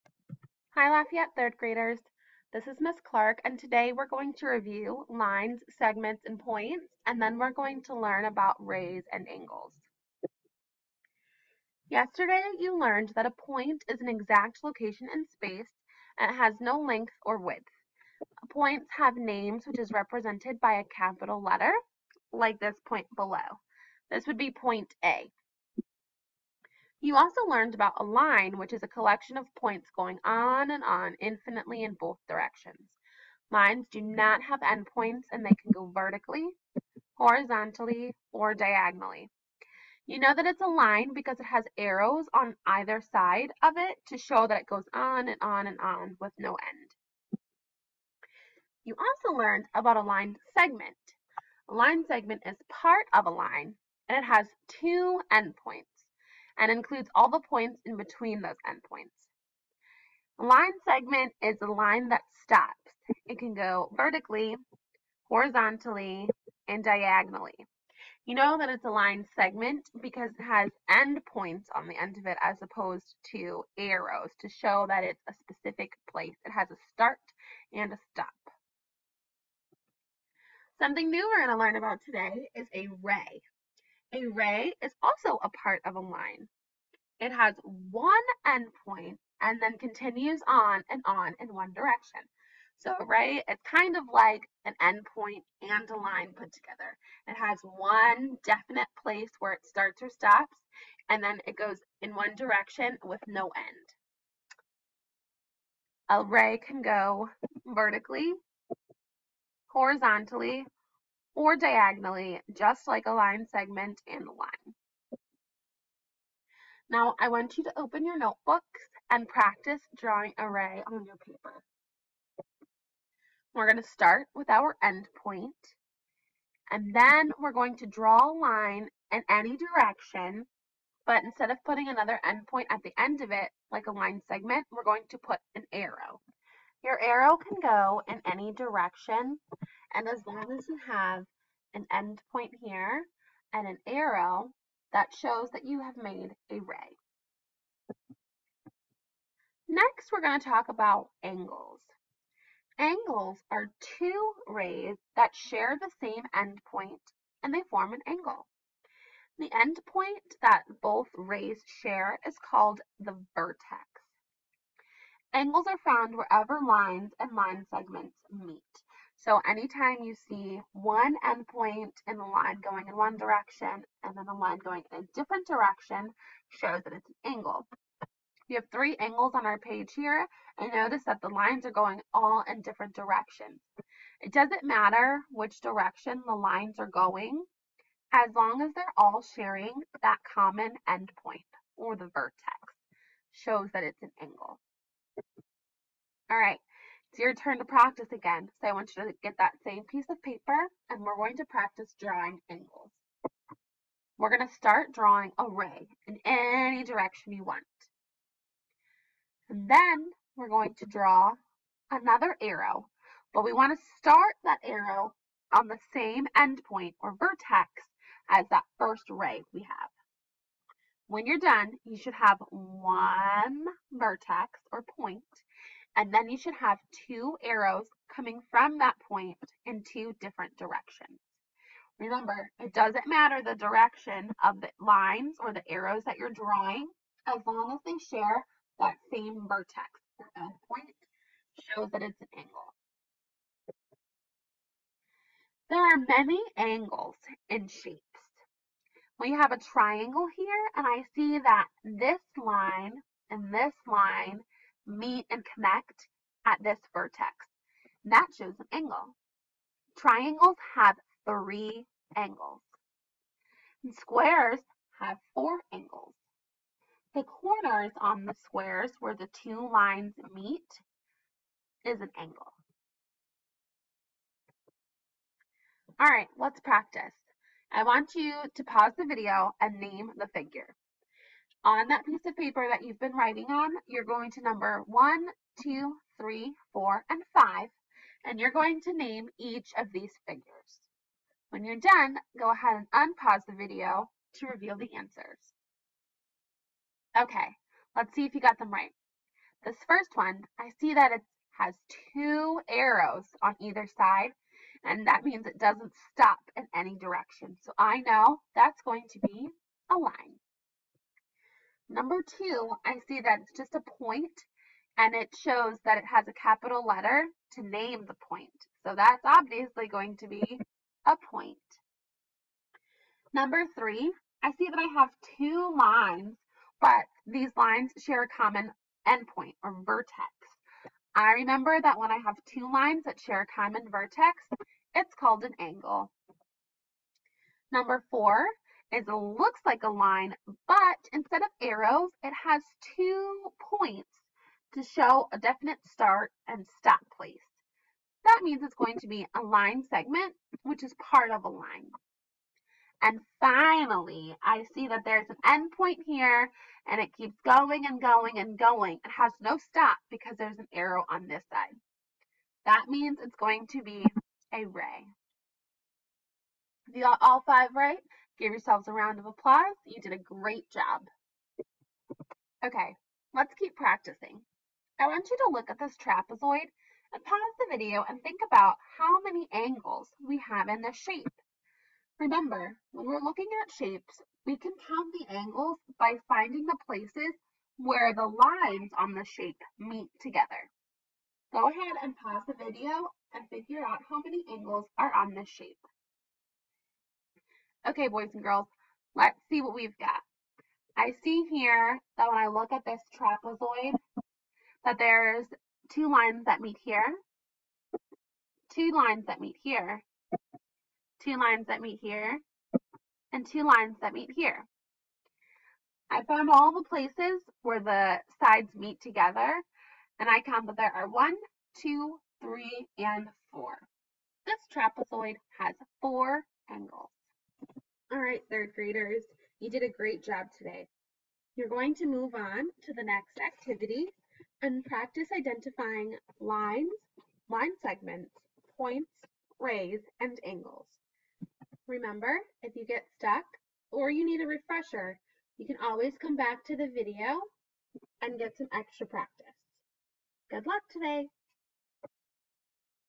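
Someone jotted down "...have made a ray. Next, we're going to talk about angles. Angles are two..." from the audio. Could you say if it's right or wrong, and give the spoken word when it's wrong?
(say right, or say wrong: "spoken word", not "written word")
right.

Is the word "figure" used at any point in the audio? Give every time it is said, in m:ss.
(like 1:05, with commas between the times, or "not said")
4:40, 4:50, 6:33.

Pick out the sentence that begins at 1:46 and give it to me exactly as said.
A ray can go vertically, horizontally, or diagonally, just like a line segment and a line.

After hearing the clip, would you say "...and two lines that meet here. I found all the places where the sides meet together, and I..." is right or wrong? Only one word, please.
right.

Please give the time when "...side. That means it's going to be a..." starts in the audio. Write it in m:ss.
6:01.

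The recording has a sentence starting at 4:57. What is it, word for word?
Okay, let's see if you got them right.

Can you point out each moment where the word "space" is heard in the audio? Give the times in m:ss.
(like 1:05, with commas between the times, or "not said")
0:15.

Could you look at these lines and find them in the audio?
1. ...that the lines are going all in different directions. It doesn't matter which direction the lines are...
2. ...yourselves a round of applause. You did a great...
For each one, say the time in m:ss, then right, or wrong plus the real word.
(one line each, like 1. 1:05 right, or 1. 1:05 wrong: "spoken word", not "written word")
1. 3:01 right
2. 6:08 right.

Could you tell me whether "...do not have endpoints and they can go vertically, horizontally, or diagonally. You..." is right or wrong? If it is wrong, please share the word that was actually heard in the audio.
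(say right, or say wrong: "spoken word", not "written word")
right.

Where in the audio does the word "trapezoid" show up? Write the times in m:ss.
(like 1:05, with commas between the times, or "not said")
6:15, 6:43, 7:04.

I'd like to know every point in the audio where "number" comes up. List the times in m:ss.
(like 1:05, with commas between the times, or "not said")
4:44, 5:11, 5:23, 5:37.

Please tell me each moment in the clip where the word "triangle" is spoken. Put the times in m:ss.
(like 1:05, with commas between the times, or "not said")
4:09, 4:19.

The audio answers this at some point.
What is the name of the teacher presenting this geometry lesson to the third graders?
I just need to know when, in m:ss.
0:02.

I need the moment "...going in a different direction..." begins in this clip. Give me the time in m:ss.
2:54.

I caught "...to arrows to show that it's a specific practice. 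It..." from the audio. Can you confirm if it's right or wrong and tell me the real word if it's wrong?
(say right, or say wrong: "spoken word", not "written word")
wrong: "place", not "practice".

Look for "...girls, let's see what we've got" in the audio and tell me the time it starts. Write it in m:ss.
6:38.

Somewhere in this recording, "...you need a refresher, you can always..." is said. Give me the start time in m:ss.
7:24.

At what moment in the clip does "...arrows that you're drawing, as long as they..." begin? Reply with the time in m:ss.
3:55.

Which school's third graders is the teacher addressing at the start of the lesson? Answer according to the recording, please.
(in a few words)
Lafayette.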